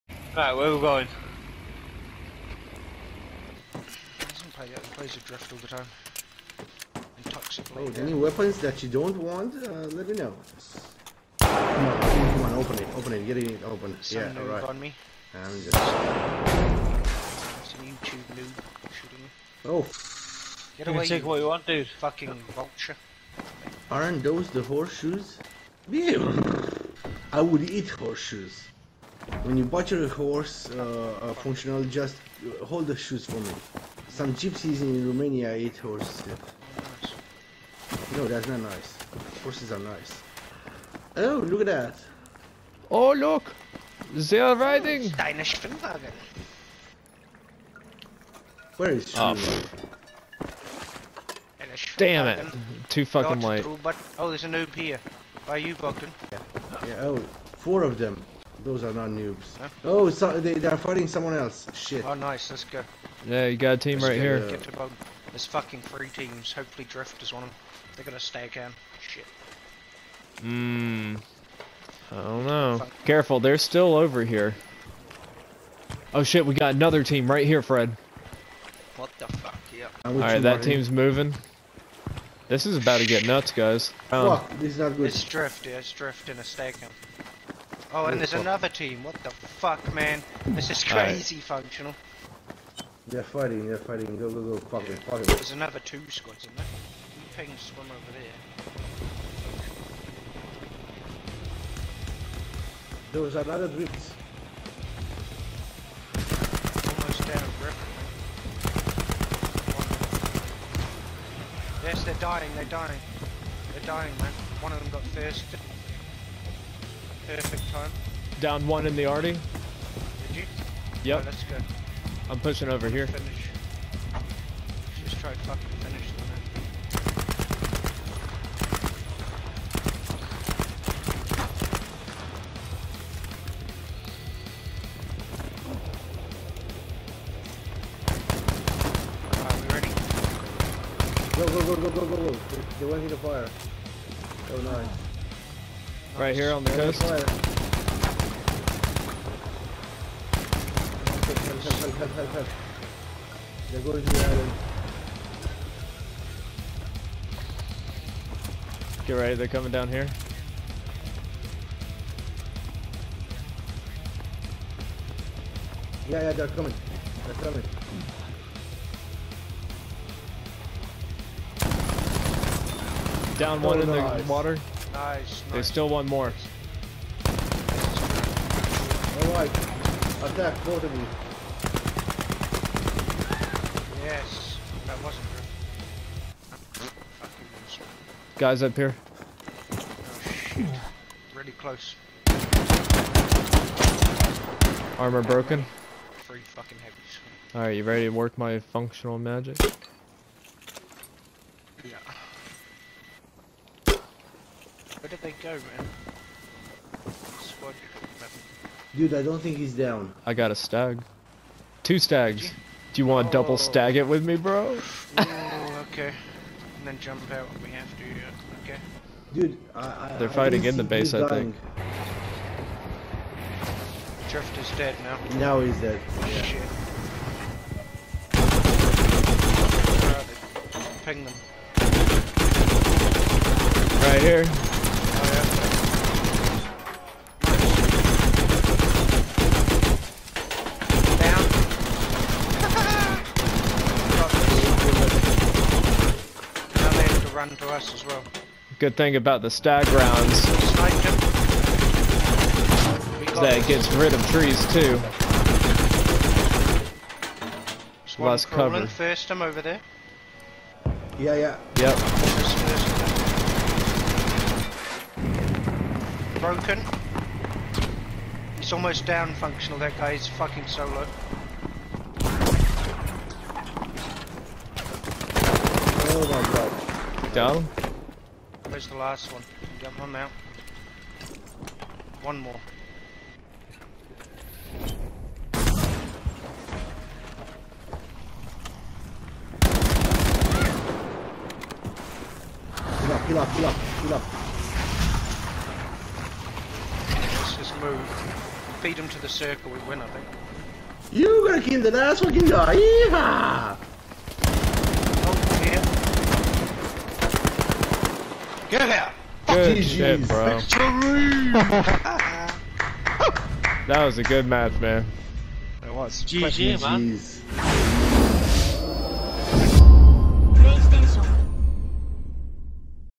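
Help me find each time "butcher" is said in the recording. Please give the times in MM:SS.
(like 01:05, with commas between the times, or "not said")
00:29.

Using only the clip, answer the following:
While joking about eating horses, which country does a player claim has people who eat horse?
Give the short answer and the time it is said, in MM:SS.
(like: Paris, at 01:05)
Romania, at 00:35.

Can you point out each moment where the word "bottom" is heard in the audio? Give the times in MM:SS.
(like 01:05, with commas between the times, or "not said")
not said.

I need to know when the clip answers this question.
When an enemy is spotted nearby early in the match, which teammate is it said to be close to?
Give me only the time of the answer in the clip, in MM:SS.
00:55.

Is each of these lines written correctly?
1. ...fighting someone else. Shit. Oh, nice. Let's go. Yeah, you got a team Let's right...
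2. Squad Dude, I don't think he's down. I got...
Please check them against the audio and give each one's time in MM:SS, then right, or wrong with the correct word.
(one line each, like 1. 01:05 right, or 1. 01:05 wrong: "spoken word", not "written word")
1. 01:00 right
2. 03:27 right.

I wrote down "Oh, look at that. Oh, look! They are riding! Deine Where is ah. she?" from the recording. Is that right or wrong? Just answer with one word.
right.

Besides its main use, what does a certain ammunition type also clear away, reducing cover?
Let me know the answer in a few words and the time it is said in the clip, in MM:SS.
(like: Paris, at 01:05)
trees, at 04:14.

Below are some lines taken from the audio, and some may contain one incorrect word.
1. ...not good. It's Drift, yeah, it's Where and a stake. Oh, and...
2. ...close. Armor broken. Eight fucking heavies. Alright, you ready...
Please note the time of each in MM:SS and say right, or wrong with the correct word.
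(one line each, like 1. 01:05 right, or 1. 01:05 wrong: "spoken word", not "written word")
1. 01:24 wrong: "Drift", not "Where"
2. 03:11 wrong: "Three", not "Eight".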